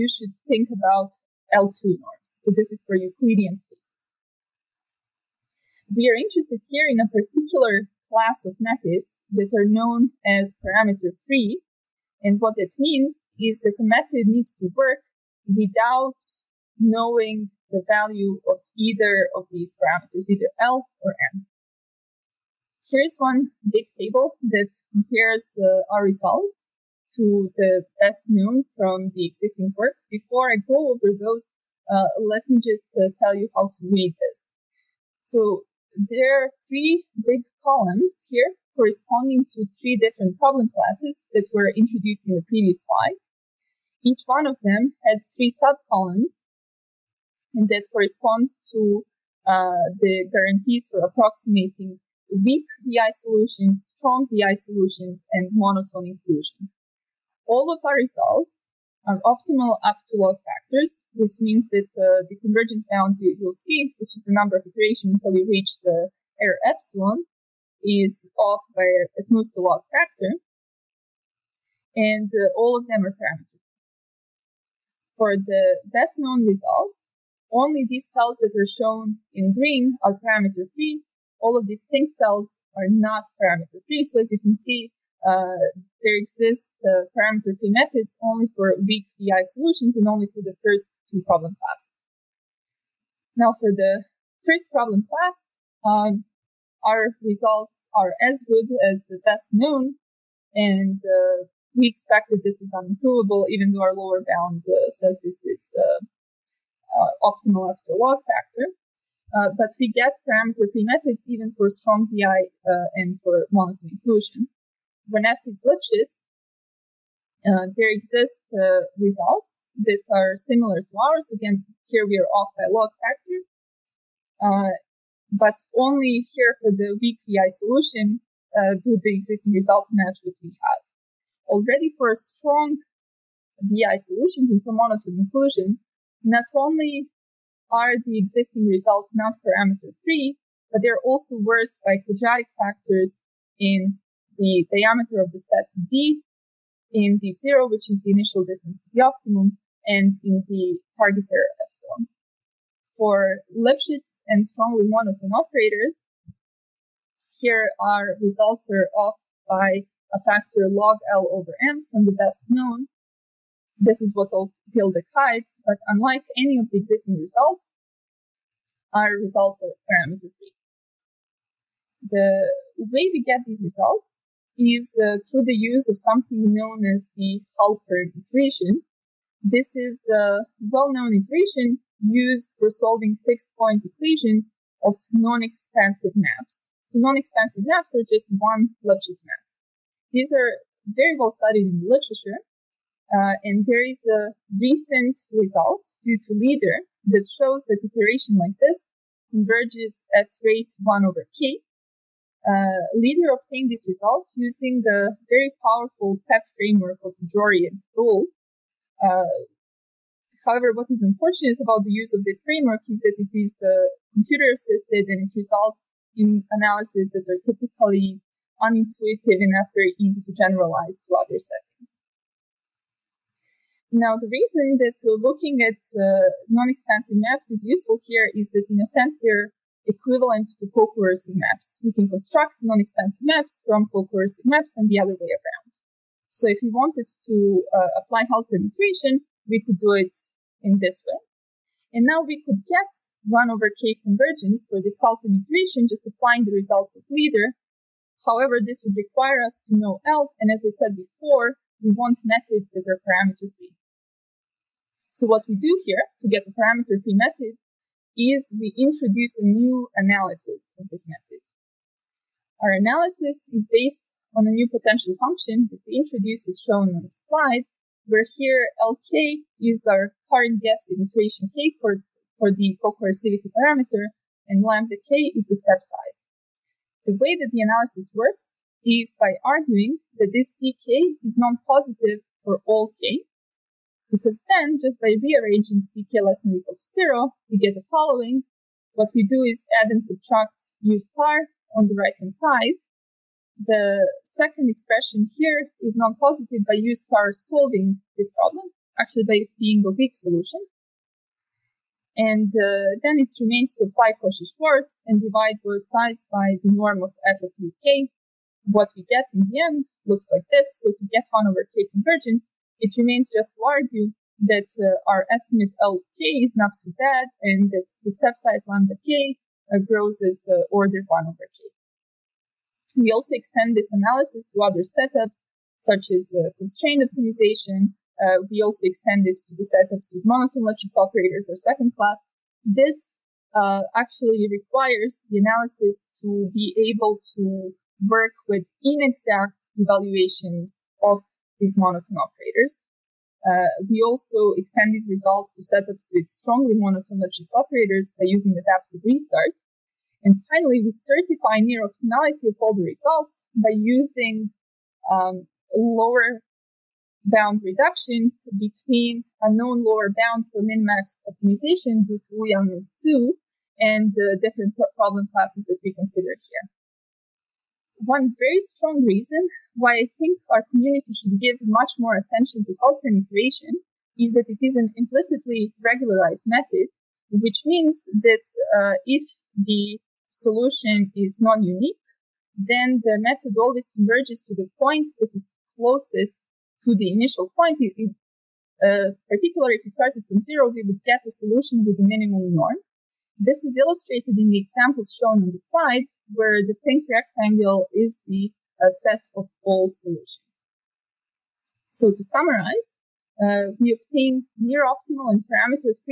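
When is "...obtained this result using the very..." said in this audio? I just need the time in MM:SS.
03:23.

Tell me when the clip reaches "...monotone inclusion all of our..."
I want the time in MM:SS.
00:55.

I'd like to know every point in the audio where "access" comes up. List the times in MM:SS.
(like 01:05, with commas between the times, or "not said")
not said.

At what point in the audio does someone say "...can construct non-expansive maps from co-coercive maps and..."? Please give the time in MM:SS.
03:51.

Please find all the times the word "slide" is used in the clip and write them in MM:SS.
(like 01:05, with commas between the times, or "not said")
00:42, 04:27, 06:35.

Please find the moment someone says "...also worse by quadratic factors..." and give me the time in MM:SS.
02:21.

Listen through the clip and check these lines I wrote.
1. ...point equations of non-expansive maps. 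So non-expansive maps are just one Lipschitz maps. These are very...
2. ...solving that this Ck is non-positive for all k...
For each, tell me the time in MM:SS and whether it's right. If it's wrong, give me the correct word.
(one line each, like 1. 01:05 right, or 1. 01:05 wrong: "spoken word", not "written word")
1. 03:03 right
2. 04:39 wrong: "arguing", not "solving".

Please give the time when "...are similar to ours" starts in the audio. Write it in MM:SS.
02:00.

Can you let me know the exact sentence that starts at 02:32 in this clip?
For Lipschitz and strongly monotone operators, here our results are off by a factor log L over M from the best known.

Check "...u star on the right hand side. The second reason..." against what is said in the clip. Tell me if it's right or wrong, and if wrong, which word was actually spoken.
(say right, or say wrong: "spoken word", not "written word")
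wrong: "expression", not "reason".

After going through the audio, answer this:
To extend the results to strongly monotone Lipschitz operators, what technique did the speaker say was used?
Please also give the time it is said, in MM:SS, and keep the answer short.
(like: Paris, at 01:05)
adaptive restart, at 05:48.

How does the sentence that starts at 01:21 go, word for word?
All of these pink cells are not parameter free.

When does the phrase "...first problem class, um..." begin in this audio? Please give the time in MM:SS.
01:34.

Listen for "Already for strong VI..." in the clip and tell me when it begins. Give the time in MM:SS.
02:11.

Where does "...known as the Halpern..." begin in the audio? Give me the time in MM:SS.
02:56.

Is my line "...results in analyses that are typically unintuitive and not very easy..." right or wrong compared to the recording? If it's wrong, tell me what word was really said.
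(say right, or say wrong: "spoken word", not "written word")
right.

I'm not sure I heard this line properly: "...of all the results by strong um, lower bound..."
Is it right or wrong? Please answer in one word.
wrong.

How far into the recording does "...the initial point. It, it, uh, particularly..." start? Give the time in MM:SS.
06:26.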